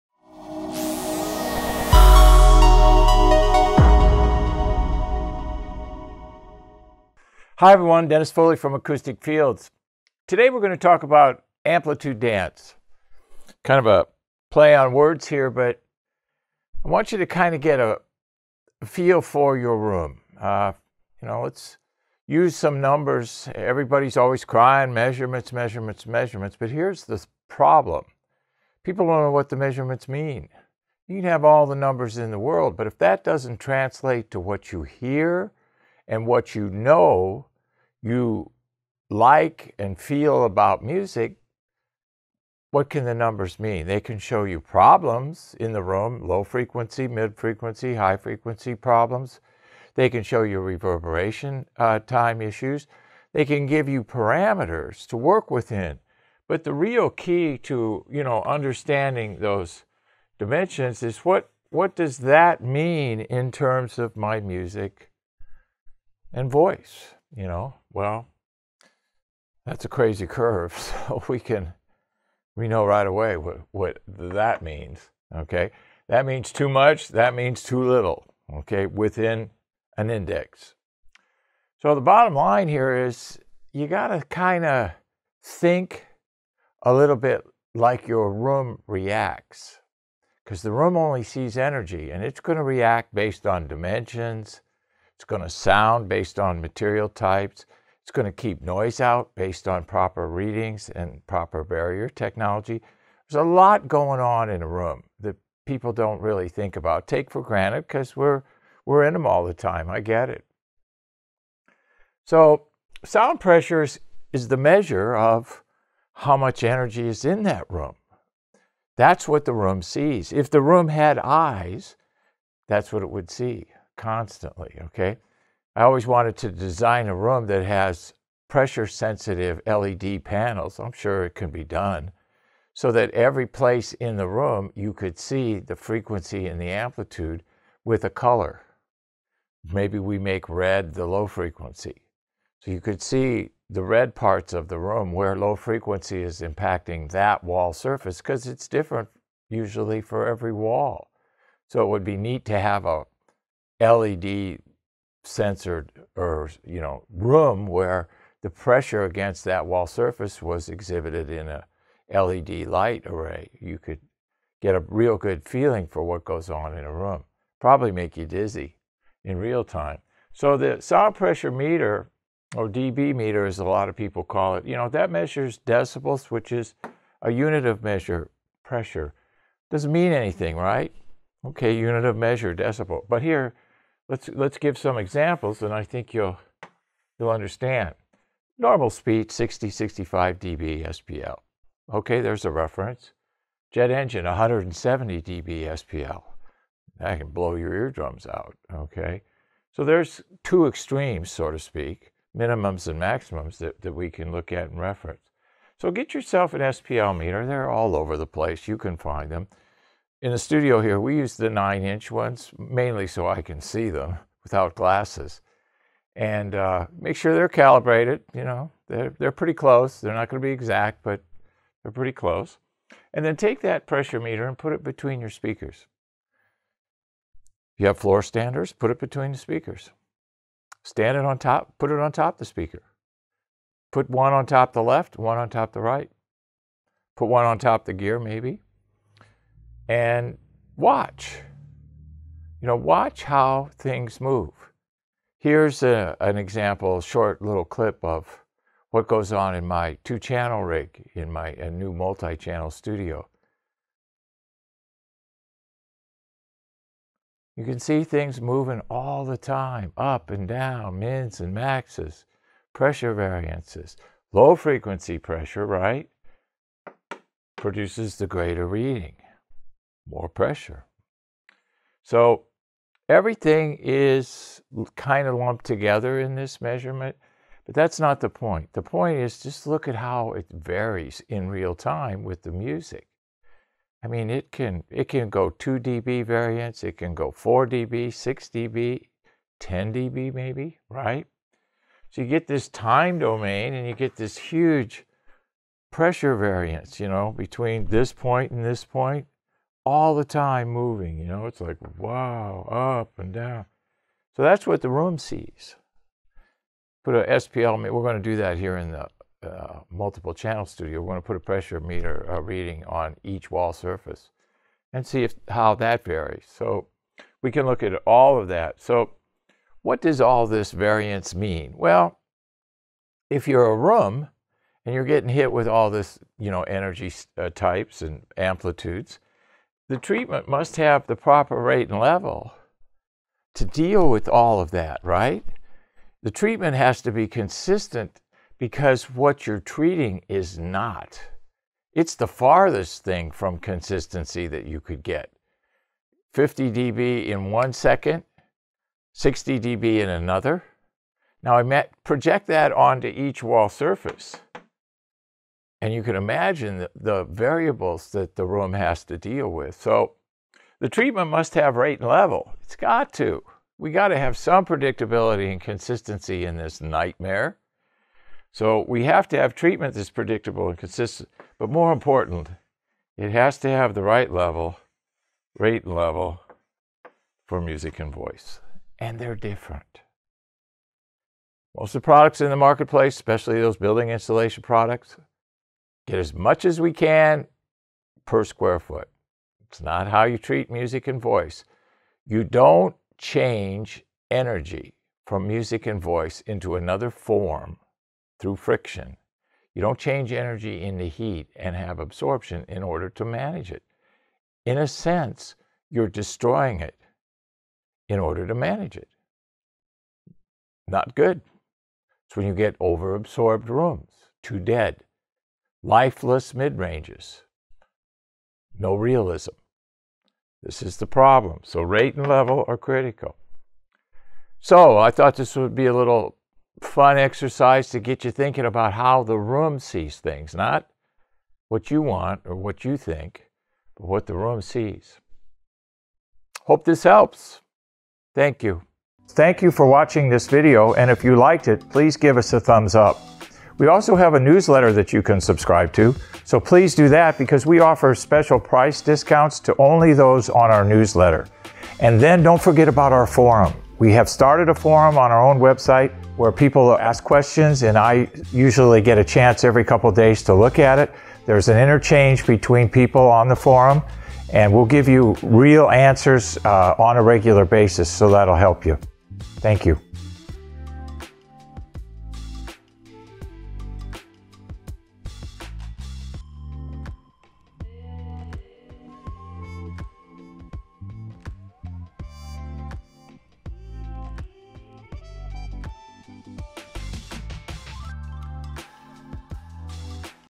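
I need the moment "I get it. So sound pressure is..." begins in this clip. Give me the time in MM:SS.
01:49.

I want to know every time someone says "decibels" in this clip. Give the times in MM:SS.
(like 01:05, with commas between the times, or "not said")
02:55, 03:02.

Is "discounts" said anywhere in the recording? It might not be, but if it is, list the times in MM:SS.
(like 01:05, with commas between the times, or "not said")
07:29.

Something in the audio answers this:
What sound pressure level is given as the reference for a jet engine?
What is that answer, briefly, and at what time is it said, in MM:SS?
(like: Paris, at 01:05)
170 dB SPL, at 03:14.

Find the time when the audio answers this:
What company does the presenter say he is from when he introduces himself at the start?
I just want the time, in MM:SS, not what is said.
00:08.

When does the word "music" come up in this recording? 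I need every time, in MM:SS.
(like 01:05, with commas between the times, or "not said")
00:40, 01:04, 04:42, 06:17, 06:30, 06:35.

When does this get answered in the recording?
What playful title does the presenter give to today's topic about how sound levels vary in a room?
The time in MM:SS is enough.
00:11.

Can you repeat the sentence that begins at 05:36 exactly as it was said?
The treatment has to be consistent because what you're treating is not.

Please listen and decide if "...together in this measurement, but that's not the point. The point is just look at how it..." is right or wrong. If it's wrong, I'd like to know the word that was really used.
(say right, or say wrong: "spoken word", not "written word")
right.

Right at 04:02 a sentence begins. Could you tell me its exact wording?
You know, watch how things move.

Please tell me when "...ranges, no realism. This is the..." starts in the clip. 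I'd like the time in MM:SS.
06:56.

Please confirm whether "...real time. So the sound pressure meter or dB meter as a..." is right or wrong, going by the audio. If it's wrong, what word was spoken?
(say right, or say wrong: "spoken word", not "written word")
right.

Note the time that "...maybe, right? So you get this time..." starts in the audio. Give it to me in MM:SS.
04:50.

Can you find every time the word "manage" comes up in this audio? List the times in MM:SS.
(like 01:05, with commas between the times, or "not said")
06:43, 06:48.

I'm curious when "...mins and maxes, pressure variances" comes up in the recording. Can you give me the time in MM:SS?
04:20.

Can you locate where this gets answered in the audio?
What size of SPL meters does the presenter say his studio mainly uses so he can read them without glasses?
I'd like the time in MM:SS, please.
03:31.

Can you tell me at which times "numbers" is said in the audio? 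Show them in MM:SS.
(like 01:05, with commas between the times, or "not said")
00:22, 00:31, 00:43.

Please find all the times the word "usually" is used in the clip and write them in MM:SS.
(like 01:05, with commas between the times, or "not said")
02:29, 07:38.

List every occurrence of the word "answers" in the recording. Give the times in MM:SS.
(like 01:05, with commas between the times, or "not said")
07:45.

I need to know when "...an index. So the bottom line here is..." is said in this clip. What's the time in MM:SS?
01:19.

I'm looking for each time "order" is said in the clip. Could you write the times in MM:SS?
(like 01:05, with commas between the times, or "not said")
06:42, 06:48.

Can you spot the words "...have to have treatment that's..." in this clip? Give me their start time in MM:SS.
06:09.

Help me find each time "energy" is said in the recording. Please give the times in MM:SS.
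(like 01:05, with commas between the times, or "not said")
01:31, 01:56, 05:26, 06:34, 06:40.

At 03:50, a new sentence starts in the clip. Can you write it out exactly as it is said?
Stand it on top, put it on top the speaker.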